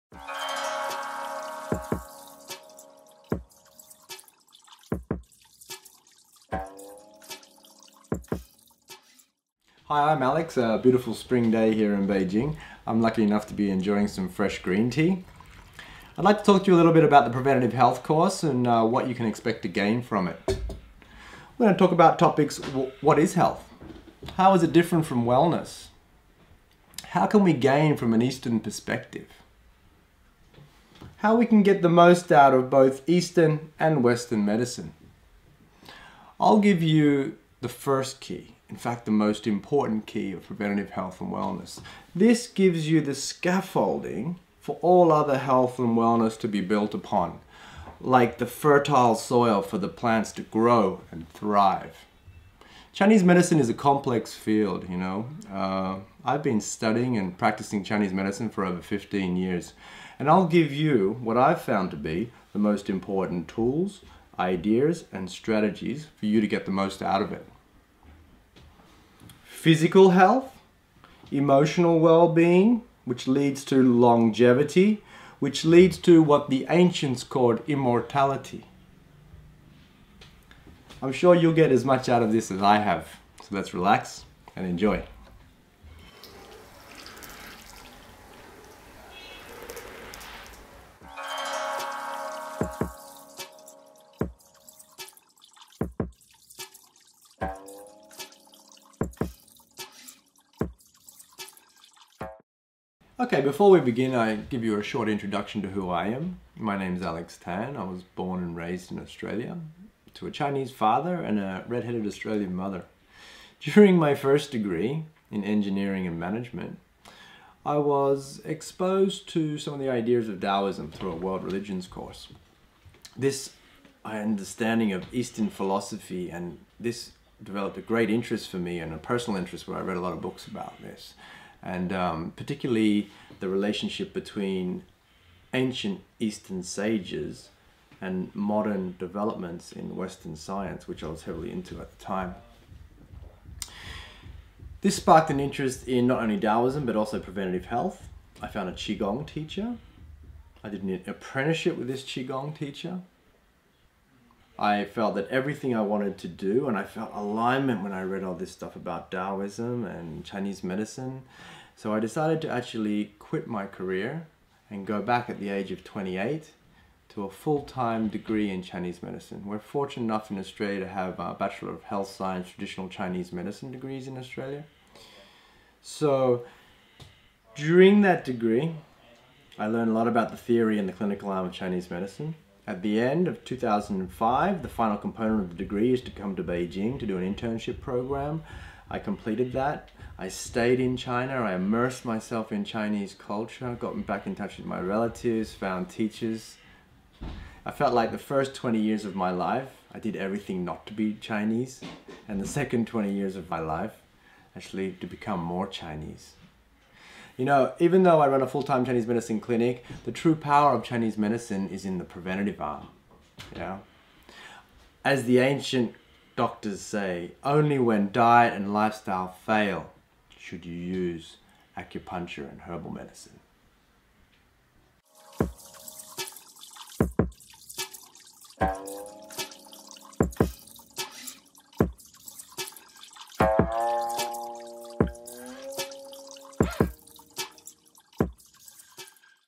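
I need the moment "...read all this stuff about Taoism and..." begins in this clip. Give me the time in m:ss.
2:38.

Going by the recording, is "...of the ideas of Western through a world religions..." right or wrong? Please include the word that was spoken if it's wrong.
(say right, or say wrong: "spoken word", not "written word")
wrong: "Taoism", not "Western".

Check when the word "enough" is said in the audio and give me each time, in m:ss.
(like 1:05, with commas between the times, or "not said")
0:13, 2:50.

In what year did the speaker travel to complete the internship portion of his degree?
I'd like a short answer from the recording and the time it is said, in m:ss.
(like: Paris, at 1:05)
2005, at 3:03.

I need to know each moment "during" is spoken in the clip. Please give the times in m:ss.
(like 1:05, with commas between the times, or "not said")
1:53, 2:57.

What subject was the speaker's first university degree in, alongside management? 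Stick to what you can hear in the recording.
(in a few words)
Engineering.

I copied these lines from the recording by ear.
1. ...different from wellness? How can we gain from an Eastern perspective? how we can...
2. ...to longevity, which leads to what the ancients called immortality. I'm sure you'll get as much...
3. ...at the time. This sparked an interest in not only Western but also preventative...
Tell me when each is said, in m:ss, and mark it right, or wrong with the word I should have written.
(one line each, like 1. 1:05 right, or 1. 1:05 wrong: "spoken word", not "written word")
1. 0:24 right
2. 1:13 right
3. 2:21 wrong: "Taoism", not "Western".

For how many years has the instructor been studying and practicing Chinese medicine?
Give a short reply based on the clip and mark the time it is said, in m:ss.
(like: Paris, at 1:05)
15, at 0:58.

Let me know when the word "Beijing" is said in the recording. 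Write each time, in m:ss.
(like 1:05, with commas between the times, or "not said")
0:12, 3:06.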